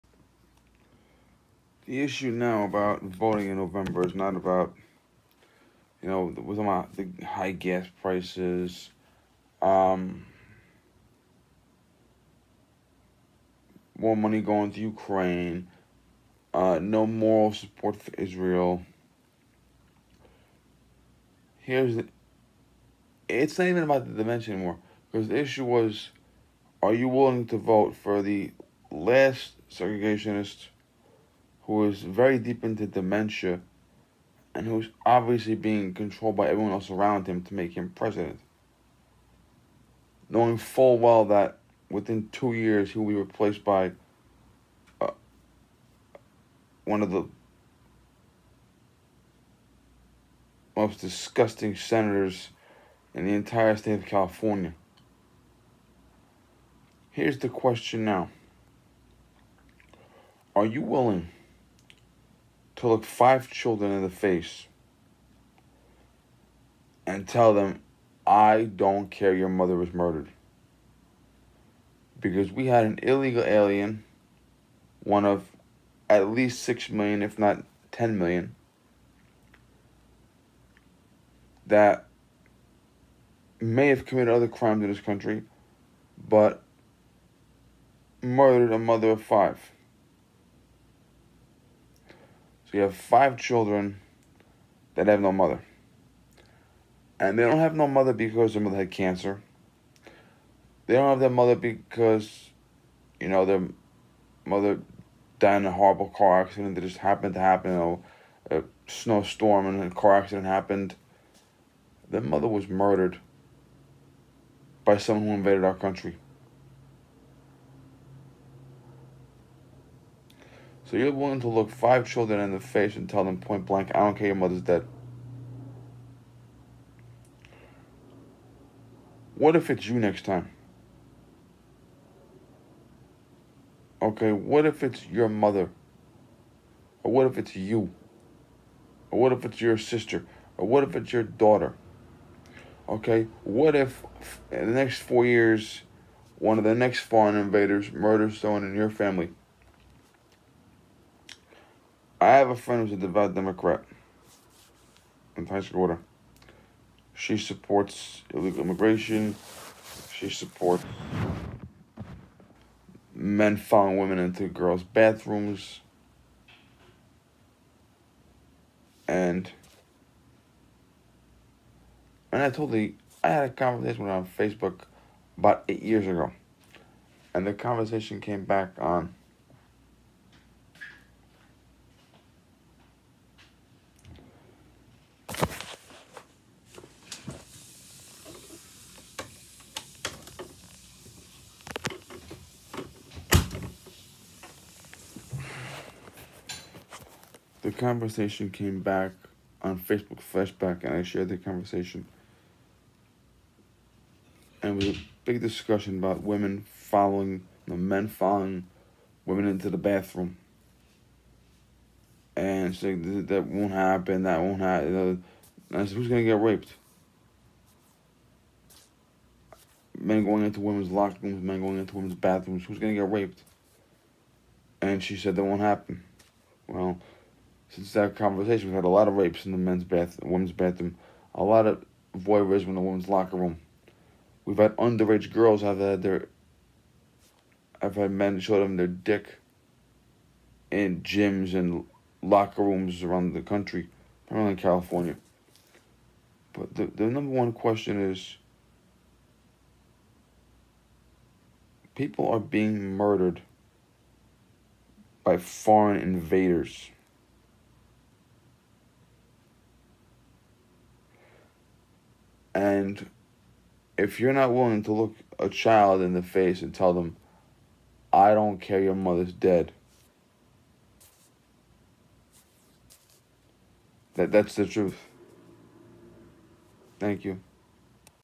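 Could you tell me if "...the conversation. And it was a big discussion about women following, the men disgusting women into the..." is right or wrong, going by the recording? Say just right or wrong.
wrong.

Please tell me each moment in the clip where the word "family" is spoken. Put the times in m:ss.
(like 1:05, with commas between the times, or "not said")
2:28.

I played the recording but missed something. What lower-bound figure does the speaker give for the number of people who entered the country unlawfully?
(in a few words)
6 million.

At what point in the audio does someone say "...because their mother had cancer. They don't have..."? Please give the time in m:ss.
1:38.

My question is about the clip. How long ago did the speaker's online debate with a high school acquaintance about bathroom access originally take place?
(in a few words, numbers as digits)
8 years ago.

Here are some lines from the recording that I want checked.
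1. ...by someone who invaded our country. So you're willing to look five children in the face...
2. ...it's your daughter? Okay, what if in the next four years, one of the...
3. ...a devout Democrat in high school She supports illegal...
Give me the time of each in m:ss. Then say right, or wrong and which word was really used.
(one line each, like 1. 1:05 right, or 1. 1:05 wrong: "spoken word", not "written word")
1. 1:54 right
2. 2:20 right
3. 2:32 right.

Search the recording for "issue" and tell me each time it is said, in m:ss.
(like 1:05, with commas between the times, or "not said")
0:02, 0:25.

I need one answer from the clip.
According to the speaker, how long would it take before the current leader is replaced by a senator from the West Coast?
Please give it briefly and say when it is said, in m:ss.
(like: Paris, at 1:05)
2 years, at 0:42.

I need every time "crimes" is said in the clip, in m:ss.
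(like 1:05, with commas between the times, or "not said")
1:24.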